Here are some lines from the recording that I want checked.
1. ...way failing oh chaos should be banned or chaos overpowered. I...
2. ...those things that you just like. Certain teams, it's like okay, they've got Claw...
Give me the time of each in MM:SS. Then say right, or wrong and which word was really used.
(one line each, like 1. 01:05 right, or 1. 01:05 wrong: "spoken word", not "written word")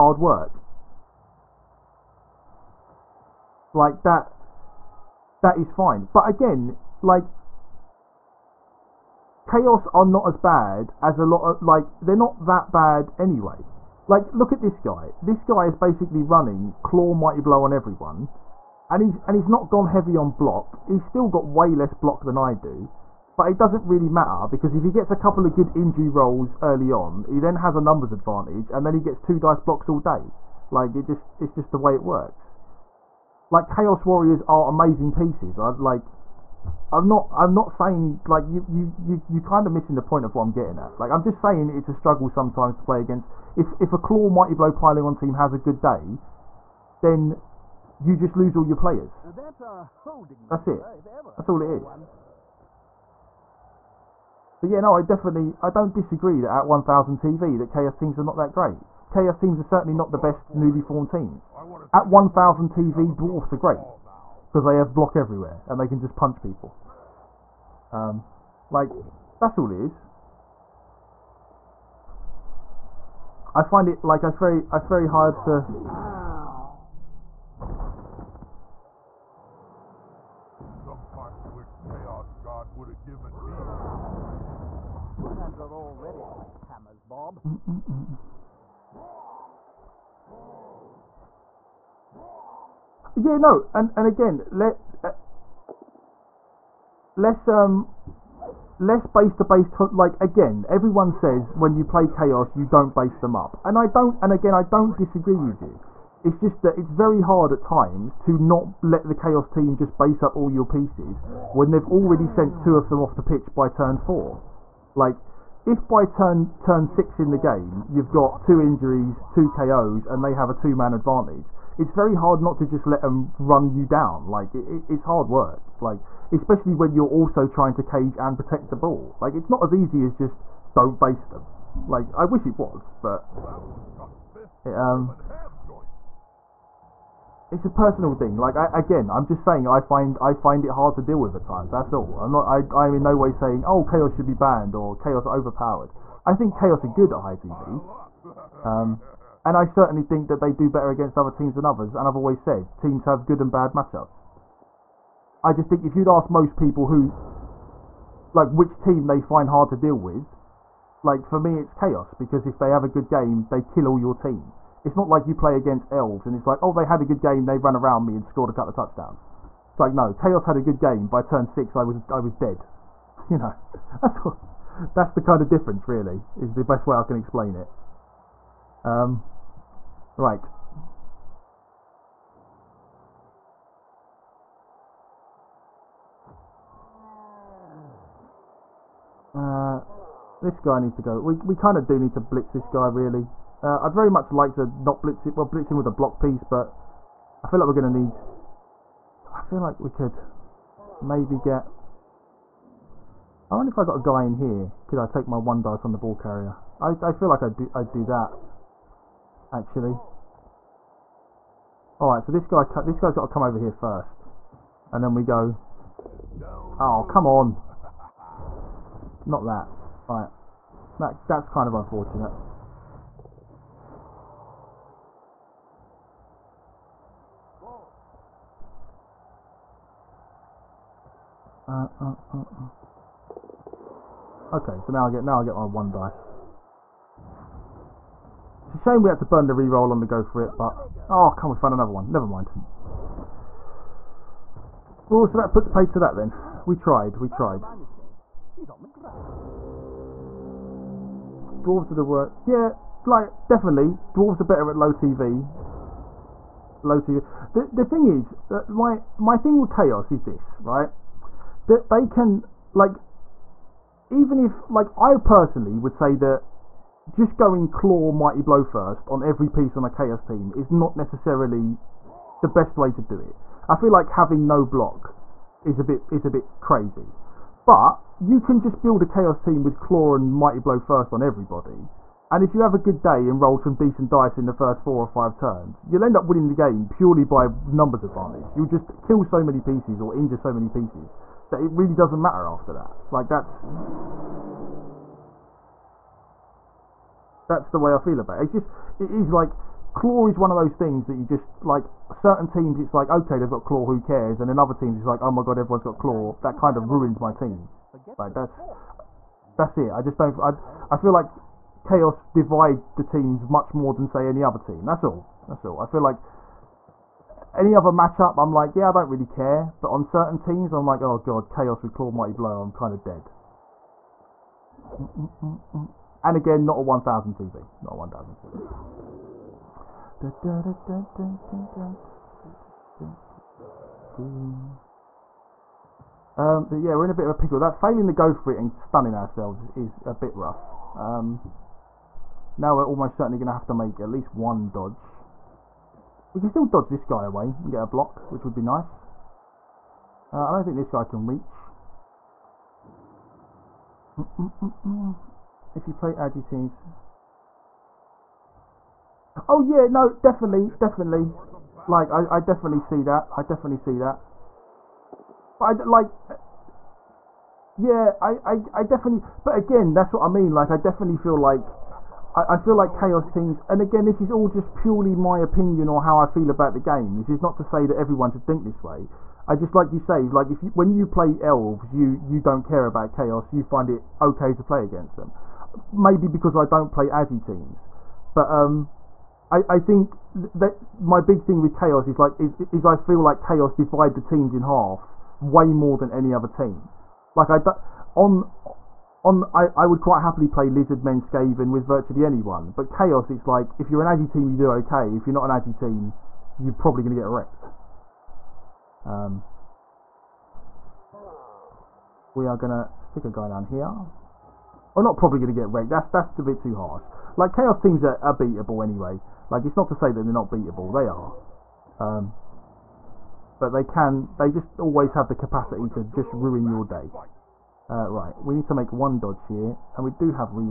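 1. 02:23 wrong: "saying", not "failing"
2. 05:00 right.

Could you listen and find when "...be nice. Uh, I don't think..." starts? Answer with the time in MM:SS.
05:48.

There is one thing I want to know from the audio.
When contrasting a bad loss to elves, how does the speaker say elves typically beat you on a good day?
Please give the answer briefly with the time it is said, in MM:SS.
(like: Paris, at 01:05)
scored a couple of touchdowns, at 02:48.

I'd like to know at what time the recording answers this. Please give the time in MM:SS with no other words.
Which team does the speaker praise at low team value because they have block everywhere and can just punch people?
01:03.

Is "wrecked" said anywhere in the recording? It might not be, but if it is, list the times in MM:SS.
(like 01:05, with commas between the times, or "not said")
06:47, 06:55.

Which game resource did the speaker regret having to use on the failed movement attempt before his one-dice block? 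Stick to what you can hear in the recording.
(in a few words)
the reroll.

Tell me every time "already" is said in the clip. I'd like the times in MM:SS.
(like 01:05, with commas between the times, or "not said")
01:25, 01:51.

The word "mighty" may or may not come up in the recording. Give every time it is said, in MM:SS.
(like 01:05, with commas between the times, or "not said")
00:17, 00:44, 04:28, 04:40, 05:22.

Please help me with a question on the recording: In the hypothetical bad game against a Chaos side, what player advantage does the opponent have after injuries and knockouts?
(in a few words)
two man advantage.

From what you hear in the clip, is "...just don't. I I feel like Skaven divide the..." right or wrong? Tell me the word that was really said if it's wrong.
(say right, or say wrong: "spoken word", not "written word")
wrong: "Chaos", not "Skaven".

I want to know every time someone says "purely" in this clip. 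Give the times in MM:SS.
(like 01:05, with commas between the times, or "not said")
04:46, 06:14.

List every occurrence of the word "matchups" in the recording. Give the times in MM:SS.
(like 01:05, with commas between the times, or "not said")
02:33, 05:17.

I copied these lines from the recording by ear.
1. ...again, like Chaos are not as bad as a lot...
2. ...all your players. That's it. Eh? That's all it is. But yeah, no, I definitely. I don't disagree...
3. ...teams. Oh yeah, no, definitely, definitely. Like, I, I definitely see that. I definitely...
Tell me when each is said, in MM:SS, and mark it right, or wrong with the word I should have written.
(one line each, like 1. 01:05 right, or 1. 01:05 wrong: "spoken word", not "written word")
1. 00:06 right
2. 00:48 right
3. 05:56 right.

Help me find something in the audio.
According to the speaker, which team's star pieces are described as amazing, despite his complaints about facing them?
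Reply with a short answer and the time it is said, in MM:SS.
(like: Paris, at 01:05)
Chaos Warriors, at 00:33.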